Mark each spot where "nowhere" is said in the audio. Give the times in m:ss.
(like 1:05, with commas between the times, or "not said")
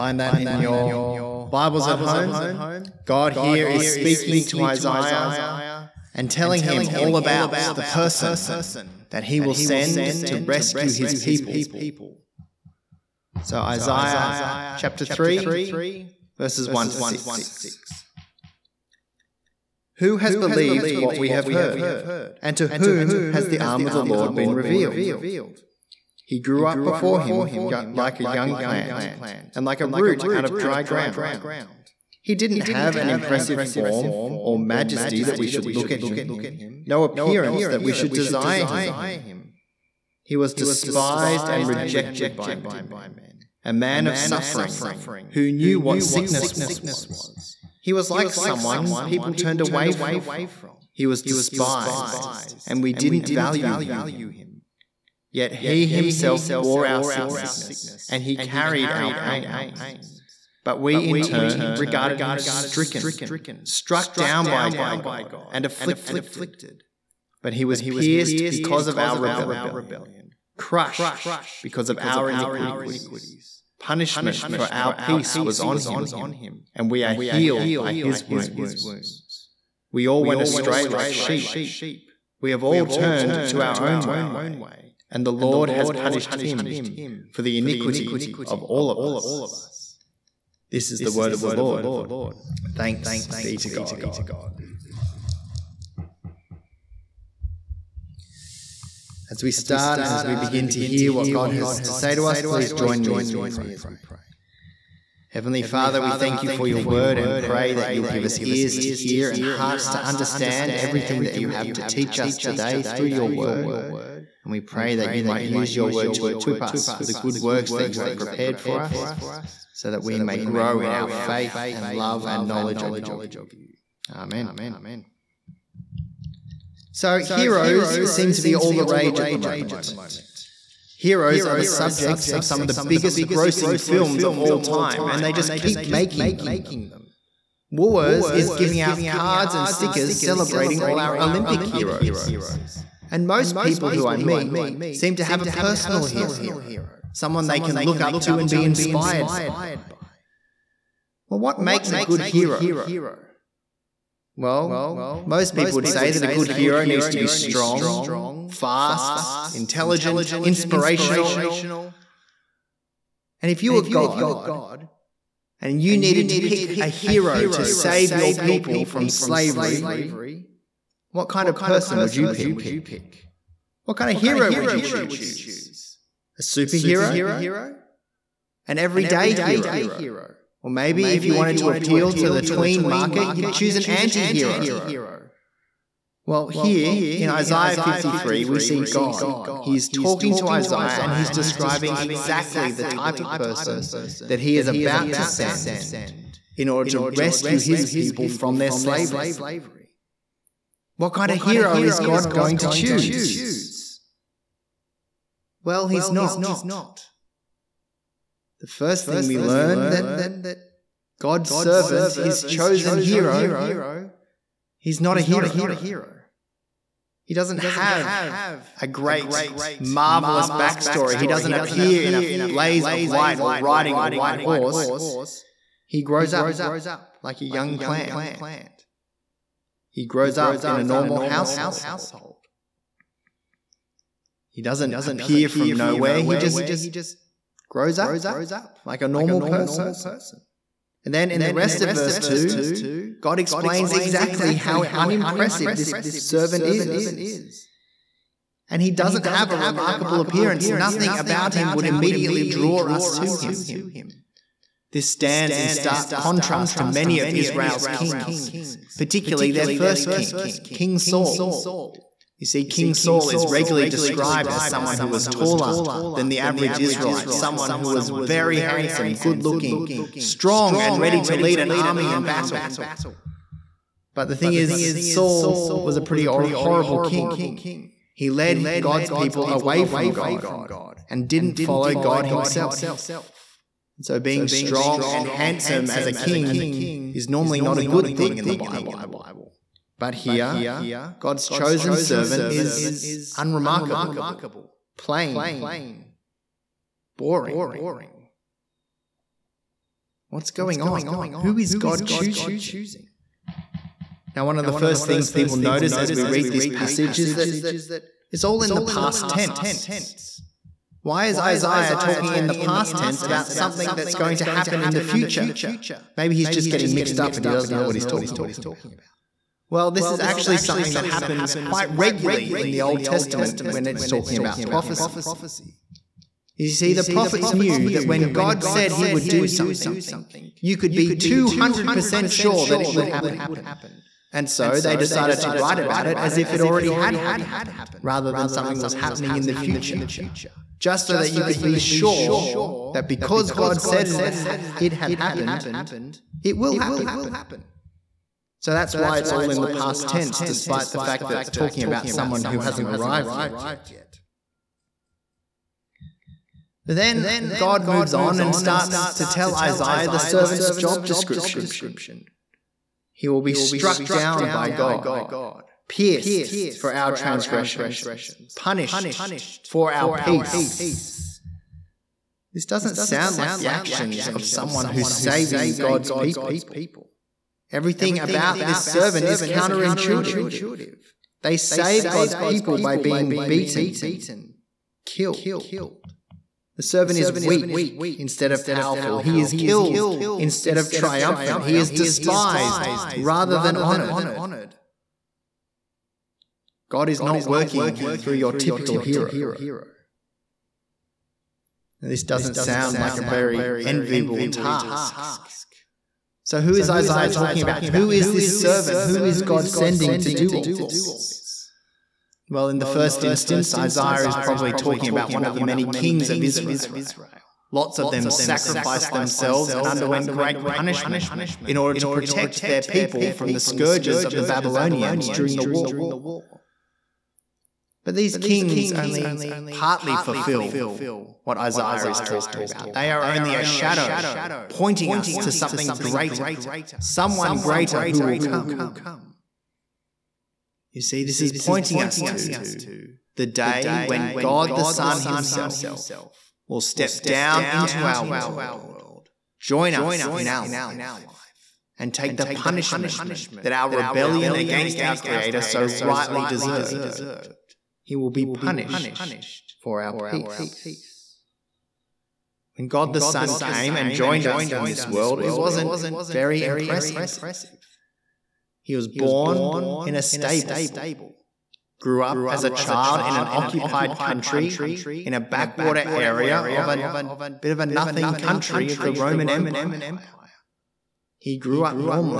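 3:55.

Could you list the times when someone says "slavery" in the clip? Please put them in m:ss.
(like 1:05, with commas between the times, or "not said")
2:49, 3:18.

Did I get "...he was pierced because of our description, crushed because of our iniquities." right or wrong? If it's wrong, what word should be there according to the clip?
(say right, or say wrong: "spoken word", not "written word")
wrong: "rebellion", not "description".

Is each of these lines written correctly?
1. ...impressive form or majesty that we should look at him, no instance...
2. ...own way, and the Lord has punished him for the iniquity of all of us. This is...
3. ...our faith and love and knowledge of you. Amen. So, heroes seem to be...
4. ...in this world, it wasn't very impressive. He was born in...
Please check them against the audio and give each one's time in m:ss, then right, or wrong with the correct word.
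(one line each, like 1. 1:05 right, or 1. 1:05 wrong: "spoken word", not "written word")
1. 0:33 wrong: "appearance", not "instance"
2. 1:23 right
3. 2:00 right
4. 7:44 right.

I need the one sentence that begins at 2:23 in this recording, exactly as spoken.
And most people who I meet seem to have a personal hero, someone they can look up to and be inspired by.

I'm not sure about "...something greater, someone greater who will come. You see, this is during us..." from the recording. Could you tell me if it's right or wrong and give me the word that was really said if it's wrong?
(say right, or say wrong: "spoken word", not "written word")
wrong: "pointing", not "during".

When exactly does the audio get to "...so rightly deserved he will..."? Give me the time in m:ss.
7:35.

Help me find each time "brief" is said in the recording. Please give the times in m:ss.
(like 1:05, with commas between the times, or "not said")
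not said.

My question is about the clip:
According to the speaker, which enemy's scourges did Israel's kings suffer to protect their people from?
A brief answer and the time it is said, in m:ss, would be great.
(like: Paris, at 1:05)
The Babylonians, at 7:04.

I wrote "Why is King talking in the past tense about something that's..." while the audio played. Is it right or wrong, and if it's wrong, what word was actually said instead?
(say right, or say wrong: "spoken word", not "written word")
wrong: "Isaiah", not "King".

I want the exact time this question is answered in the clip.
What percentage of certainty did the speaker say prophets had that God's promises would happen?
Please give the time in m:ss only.
5:31.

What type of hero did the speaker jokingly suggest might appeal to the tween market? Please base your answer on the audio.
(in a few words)
An anti hero.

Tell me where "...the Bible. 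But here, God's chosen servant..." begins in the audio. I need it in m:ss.
4:48.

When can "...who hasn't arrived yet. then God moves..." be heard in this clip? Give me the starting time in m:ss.
5:52.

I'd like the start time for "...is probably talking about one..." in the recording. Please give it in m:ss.
6:54.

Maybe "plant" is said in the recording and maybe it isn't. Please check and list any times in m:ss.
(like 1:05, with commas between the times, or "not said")
0:28, 3:47.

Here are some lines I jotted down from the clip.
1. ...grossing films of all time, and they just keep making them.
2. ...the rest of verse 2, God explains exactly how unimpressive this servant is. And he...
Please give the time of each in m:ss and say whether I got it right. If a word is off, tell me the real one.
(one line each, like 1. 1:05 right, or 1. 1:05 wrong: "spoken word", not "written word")
1. 2:13 right
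2. 4:01 right.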